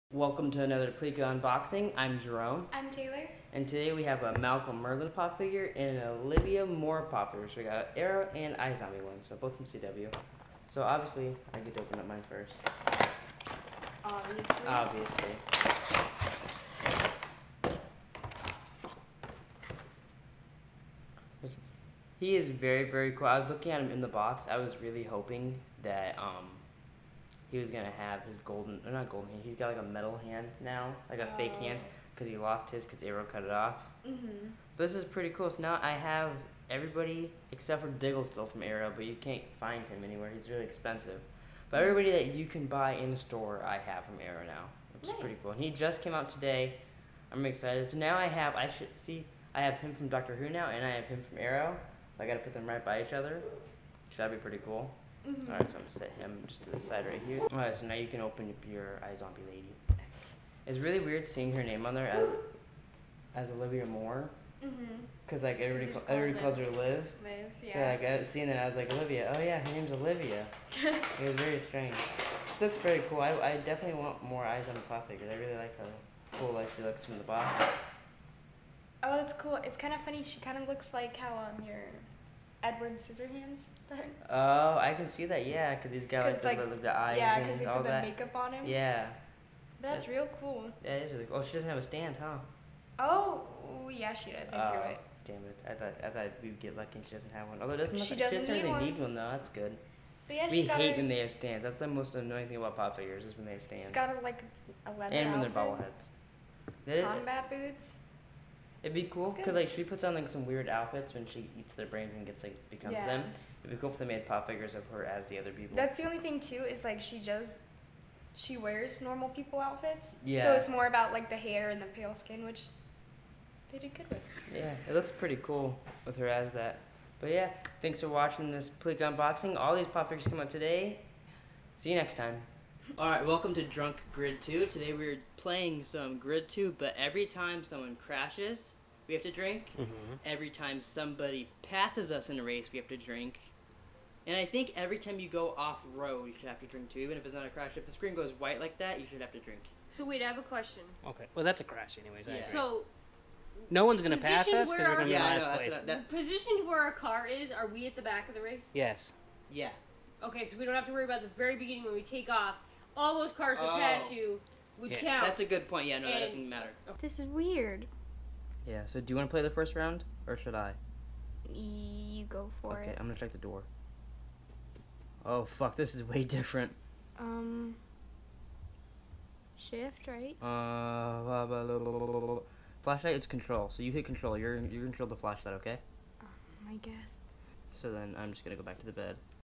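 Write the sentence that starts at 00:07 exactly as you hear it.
So we got Arrow and iZombie one, so both from CW.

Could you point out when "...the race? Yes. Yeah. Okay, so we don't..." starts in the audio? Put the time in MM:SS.
02:38.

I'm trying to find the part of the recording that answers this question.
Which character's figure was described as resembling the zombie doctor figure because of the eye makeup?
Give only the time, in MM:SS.
01:22.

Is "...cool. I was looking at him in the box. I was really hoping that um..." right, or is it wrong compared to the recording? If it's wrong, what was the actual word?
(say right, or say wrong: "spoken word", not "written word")
right.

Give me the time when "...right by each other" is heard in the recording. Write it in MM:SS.
00:52.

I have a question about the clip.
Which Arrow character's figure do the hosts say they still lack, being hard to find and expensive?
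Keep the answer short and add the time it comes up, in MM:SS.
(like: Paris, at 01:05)
Diggle, at 00:37.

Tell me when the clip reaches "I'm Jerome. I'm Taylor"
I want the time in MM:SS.
00:01.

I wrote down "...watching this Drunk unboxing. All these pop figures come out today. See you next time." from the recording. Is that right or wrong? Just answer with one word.
wrong.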